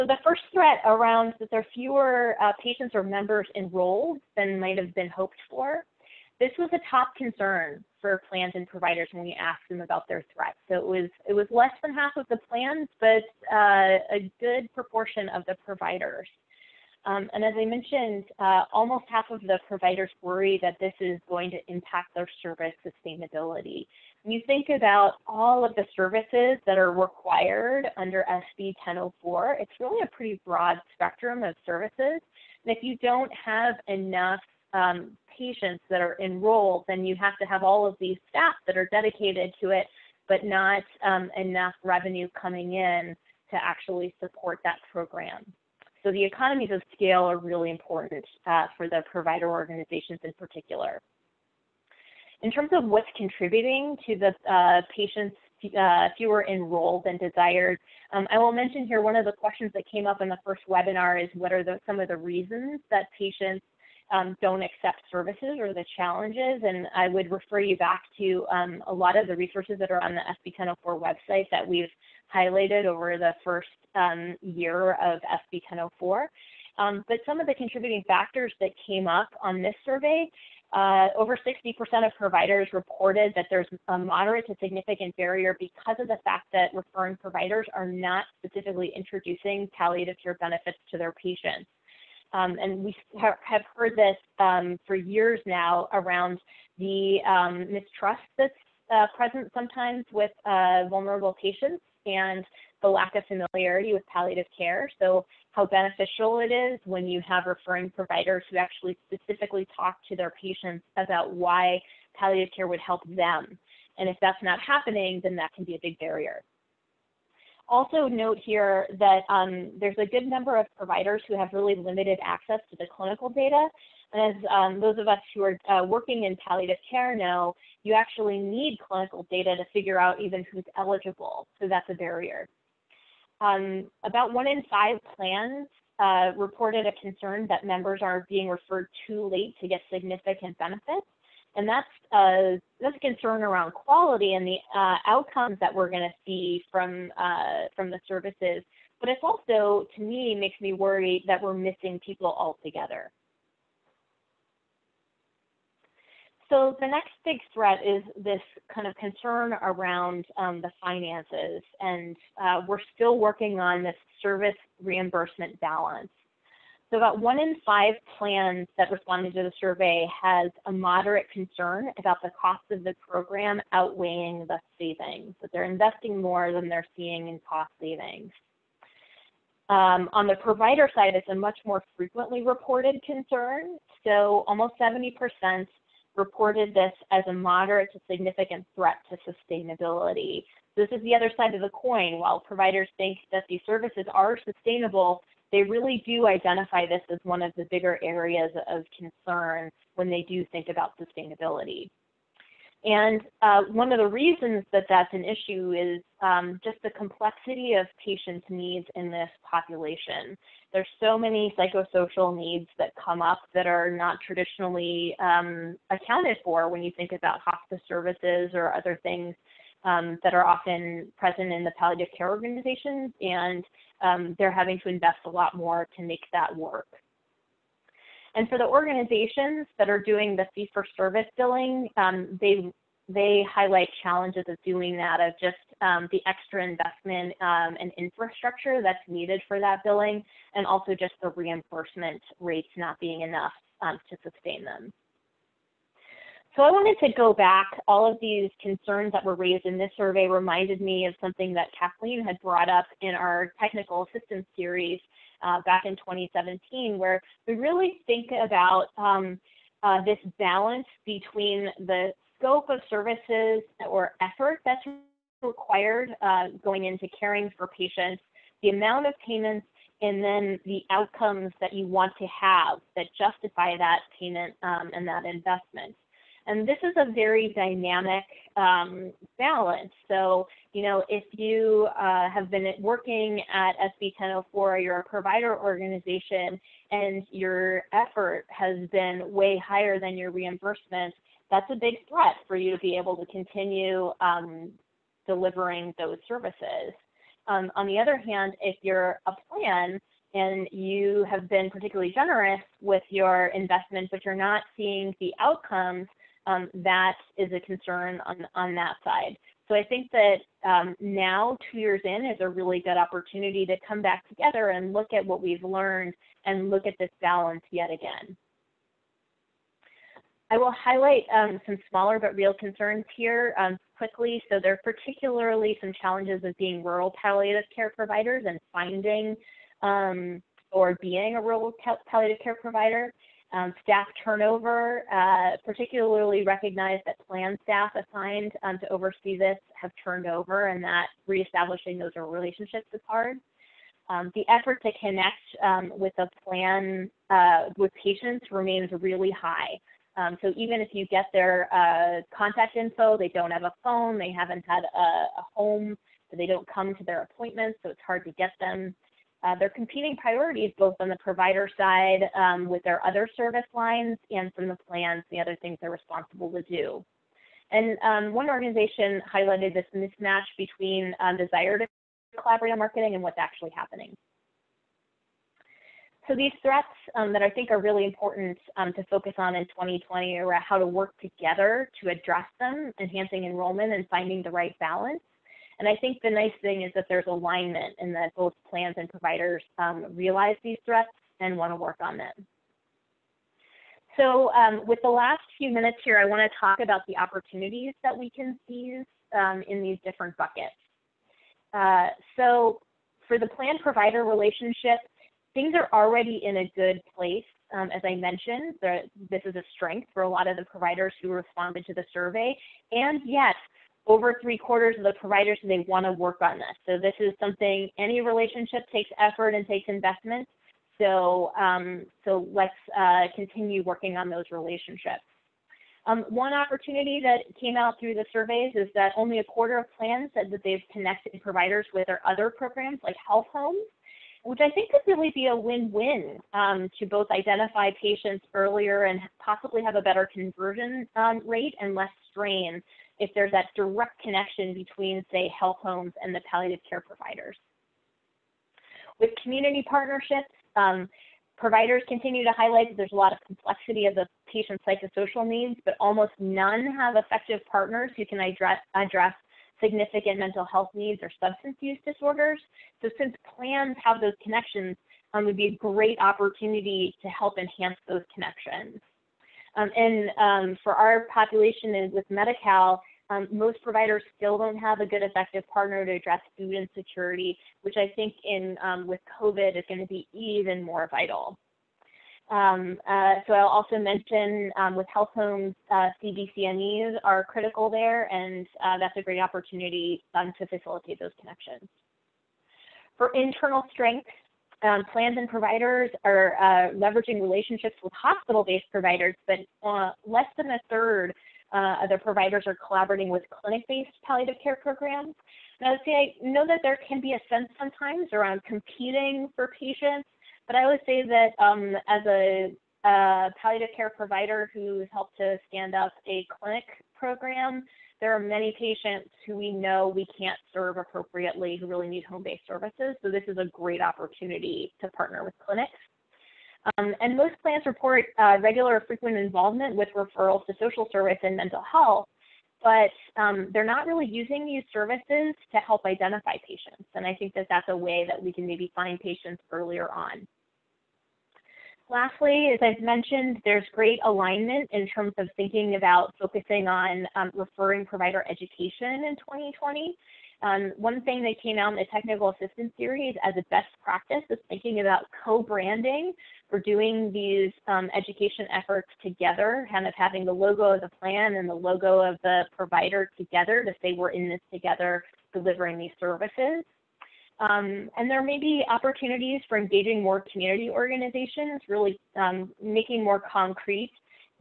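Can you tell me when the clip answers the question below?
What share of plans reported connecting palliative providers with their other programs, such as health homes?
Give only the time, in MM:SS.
07:09.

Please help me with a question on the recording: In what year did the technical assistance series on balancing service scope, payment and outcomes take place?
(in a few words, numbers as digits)
2017.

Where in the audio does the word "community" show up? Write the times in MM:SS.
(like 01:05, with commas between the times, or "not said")
07:29, 09:30.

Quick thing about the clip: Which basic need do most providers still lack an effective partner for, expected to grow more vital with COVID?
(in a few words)
food insecurity.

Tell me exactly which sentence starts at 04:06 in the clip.
So I wanted to go back.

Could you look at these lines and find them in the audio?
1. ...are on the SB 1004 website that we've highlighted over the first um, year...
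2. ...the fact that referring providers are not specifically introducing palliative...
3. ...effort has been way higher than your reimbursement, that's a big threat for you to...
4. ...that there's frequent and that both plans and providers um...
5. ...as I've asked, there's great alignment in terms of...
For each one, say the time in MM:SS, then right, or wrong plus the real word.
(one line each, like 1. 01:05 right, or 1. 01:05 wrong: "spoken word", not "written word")
1. 01:09 right
2. 01:26 right
3. 04:47 right
4. 06:26 wrong: "alignment", not "frequent"
5. 09:02 wrong: "mentioned", not "asked".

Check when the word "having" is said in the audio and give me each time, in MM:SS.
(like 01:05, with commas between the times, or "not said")
03:44, 09:20.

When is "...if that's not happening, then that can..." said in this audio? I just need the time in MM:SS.
01:54.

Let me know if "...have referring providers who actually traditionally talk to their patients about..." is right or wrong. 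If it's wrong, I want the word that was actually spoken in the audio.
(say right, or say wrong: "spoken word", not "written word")
wrong: "specifically", not "traditionally".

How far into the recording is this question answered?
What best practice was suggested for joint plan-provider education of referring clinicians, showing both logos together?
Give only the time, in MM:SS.
09:15.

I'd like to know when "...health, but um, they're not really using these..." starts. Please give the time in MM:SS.
08:51.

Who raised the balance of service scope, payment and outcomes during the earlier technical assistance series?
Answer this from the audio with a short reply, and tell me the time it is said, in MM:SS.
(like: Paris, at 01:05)
Kathleen, at 04:11.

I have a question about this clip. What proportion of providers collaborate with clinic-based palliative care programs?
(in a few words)
less than a third.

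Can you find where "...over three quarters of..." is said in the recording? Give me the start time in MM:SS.
06:54.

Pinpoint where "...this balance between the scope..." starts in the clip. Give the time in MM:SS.
04:20.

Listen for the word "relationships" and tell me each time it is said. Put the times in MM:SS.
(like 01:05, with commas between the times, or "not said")
05:42, 06:44, 06:58, 07:04, 08:17.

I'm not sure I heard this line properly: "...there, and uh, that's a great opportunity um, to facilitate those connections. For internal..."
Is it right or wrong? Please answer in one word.
right.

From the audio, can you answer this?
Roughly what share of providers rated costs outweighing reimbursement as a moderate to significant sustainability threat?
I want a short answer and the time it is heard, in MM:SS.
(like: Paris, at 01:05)
almost 70%, at 03:04.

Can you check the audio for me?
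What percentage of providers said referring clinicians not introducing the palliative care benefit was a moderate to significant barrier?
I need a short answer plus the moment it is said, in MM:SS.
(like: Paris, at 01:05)
over 60%, at 01:21.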